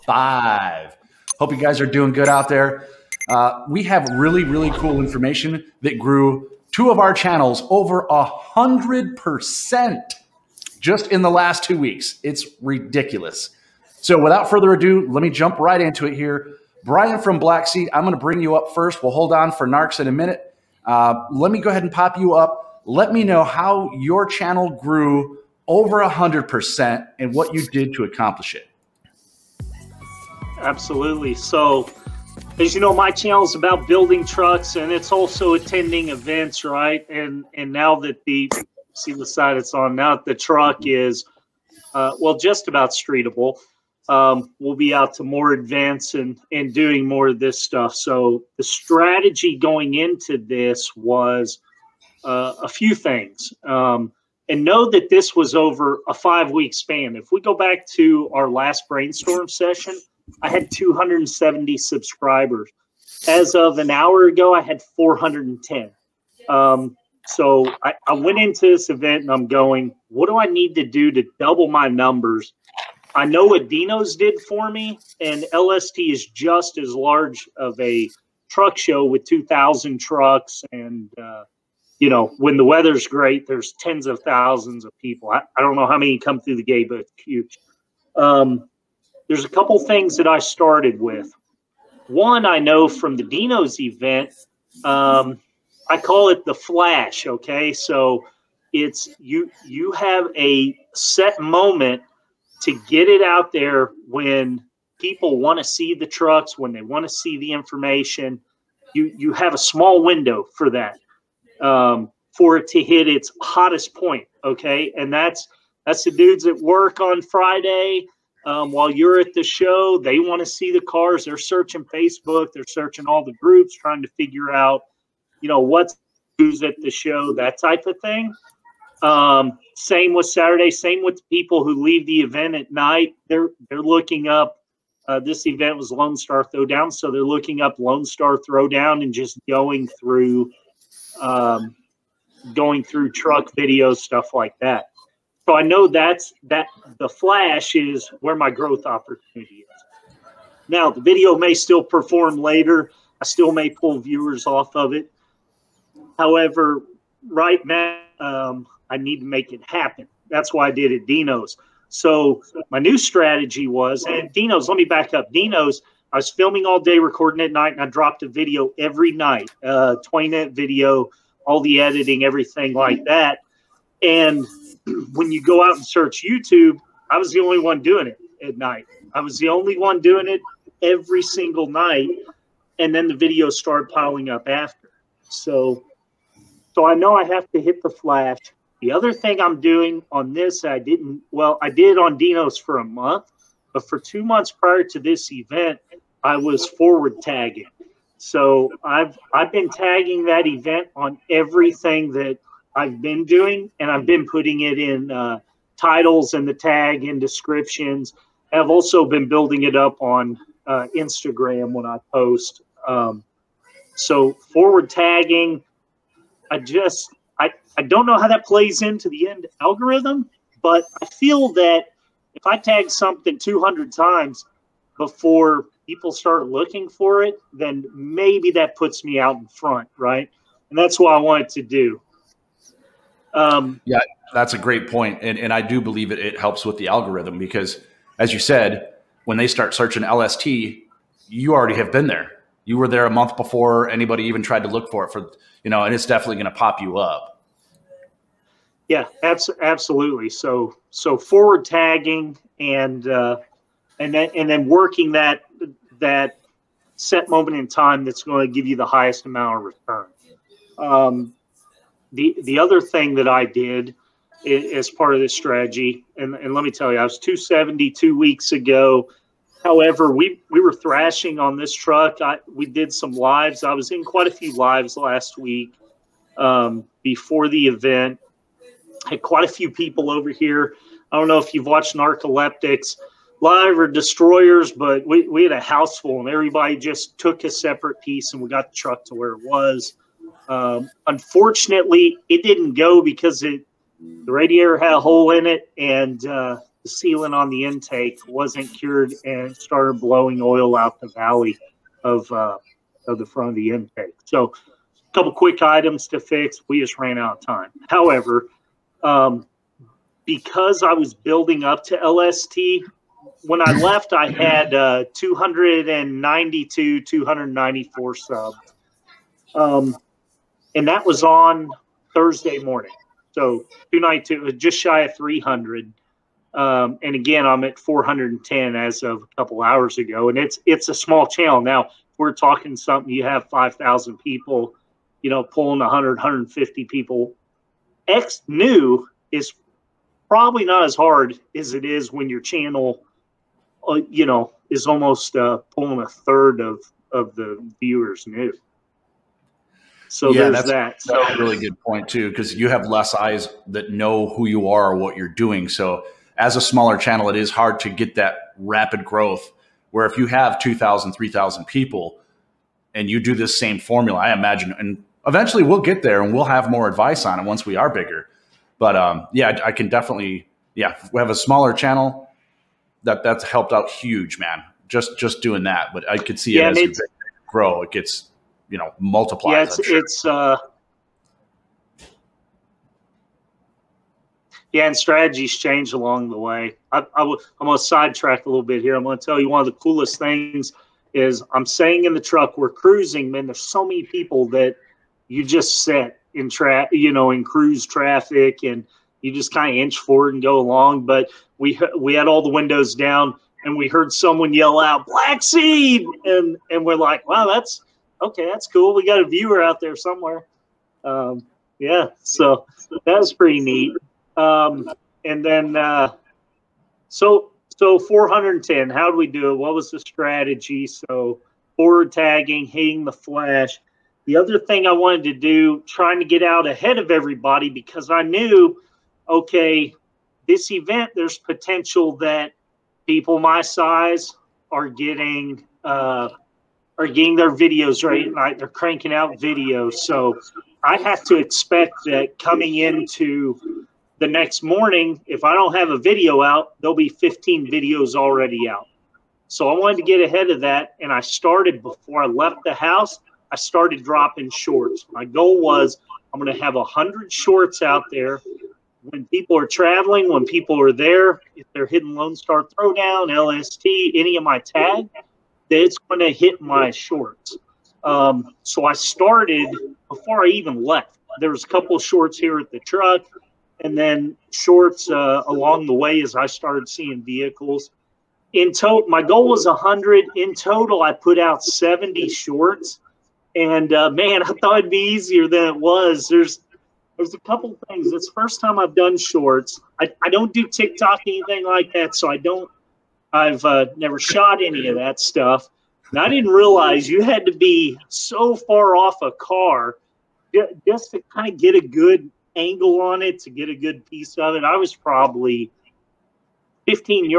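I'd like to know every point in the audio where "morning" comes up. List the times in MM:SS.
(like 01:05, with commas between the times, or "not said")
05:22, 07:24.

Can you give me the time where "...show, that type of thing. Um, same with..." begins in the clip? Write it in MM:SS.
02:06.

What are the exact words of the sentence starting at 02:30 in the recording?
Now the video may still perform later.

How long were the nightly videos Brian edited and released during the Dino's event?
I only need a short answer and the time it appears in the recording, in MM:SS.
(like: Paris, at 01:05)
20 minutes, at 02:50.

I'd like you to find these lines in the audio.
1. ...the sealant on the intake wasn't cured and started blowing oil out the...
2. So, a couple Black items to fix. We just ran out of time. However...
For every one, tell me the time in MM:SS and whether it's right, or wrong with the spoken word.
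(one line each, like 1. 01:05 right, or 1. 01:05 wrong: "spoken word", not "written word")
1. 04:56 right
2. 05:04 wrong: "quick", not "Black".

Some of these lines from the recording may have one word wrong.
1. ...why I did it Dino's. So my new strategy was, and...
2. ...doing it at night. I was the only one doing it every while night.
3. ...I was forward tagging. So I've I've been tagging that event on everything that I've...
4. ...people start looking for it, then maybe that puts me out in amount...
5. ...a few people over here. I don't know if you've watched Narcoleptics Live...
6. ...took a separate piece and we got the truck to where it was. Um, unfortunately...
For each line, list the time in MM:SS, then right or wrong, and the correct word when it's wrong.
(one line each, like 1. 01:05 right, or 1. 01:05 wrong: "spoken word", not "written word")
1. 02:40 right
2. 02:57 wrong: "single", not "while"
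3. 03:16 right
4. 03:45 wrong: "front", not "amount"
5. 04:39 right
6. 04:47 right.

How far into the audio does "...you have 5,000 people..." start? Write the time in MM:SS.
05:33.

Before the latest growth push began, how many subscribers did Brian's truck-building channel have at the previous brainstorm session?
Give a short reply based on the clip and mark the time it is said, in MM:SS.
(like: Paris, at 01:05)
270, at 01:00.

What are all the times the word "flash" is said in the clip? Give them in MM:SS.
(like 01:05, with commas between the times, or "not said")
01:36, 02:27, 03:07, 07:03.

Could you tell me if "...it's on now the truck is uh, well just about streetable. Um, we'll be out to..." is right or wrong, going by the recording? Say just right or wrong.
right.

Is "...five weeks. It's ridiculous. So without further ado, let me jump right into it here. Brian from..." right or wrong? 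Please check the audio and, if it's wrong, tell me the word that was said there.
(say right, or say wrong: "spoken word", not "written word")
wrong: "two", not "five".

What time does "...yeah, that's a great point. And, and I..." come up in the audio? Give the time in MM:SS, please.
03:53.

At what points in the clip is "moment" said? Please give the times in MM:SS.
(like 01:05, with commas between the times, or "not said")
01:41, 04:17.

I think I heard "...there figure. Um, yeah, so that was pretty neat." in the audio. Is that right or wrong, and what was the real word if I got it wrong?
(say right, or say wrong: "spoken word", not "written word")
wrong: "somewhere", not "figure".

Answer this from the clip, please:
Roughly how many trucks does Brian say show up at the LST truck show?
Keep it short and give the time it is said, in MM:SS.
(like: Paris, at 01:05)
2,000, at 01:19.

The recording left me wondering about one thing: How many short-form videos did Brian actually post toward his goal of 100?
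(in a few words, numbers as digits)
70.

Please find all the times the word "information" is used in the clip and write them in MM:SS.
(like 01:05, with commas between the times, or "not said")
00:05, 01:47.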